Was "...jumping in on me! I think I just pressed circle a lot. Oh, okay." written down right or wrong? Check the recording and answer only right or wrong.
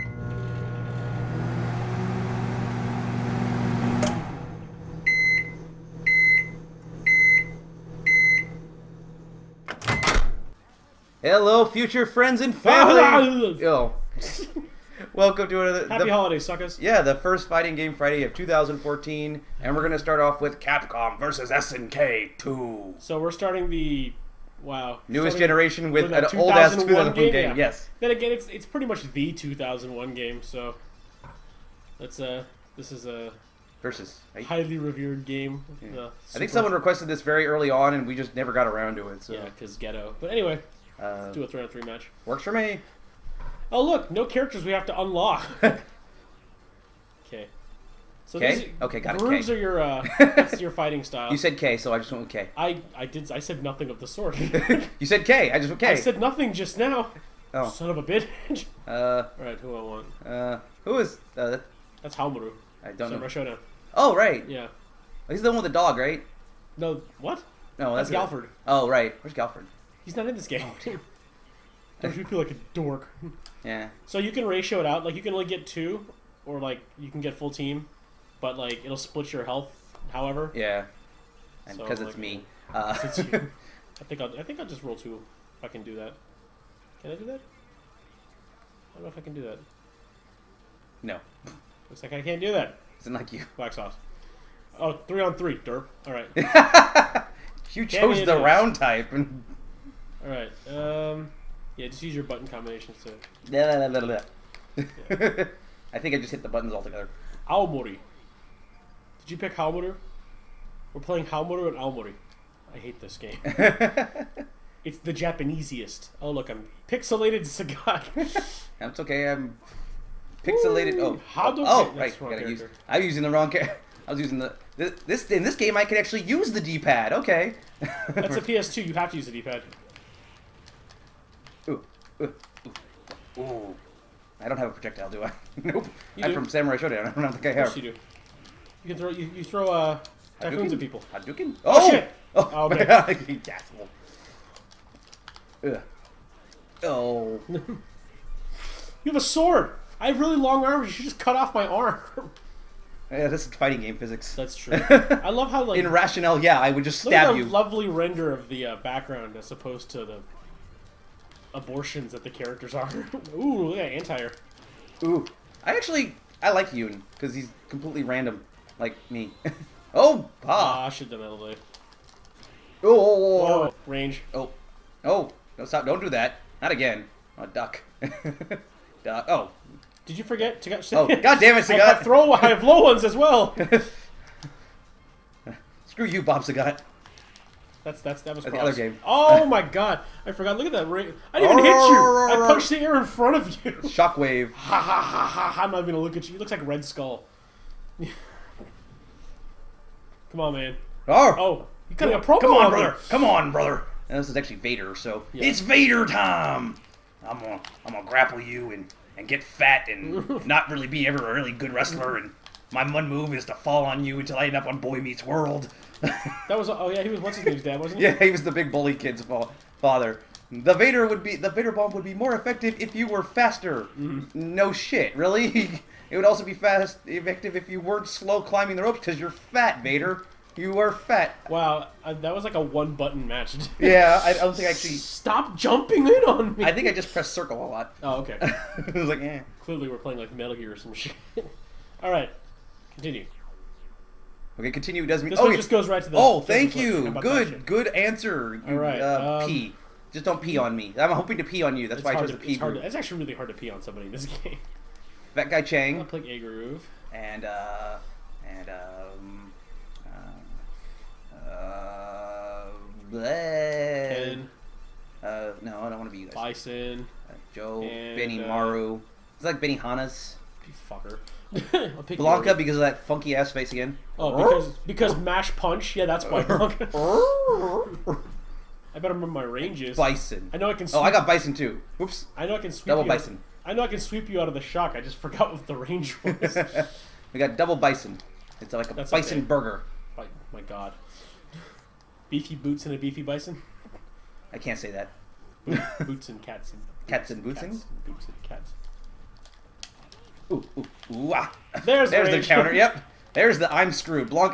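right.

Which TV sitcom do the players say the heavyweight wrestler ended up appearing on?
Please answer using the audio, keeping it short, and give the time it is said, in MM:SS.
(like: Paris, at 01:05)
Boy Meets World, at 03:34.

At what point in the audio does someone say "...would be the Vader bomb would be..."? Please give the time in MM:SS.
03:41.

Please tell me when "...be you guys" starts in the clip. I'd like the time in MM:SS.
04:26.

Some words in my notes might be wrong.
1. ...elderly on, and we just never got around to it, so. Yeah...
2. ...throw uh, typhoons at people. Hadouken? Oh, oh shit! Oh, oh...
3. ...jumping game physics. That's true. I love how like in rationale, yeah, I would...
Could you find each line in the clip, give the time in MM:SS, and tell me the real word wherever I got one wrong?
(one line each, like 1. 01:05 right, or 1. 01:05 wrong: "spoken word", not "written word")
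1. 00:37 wrong: "early", not "elderly"
2. 02:19 right
3. 02:33 wrong: "fighting", not "jumping".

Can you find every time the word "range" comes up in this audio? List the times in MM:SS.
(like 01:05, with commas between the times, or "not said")
02:53, 04:39, 04:45.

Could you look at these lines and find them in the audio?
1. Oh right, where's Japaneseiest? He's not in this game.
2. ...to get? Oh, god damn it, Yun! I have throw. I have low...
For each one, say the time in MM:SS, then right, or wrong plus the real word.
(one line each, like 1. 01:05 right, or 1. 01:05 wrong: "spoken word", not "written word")
1. 01:08 wrong: "Galford", not "Japaneseiest"
2. 03:00 wrong: "Sagat", not "Yun".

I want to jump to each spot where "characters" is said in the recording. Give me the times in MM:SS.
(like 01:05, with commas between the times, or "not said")
00:44, 02:03, 02:42.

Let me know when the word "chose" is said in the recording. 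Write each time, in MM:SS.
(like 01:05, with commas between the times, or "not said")
01:37, 04:12.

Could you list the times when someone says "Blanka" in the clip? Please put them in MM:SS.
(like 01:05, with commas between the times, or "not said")
04:32, 04:36.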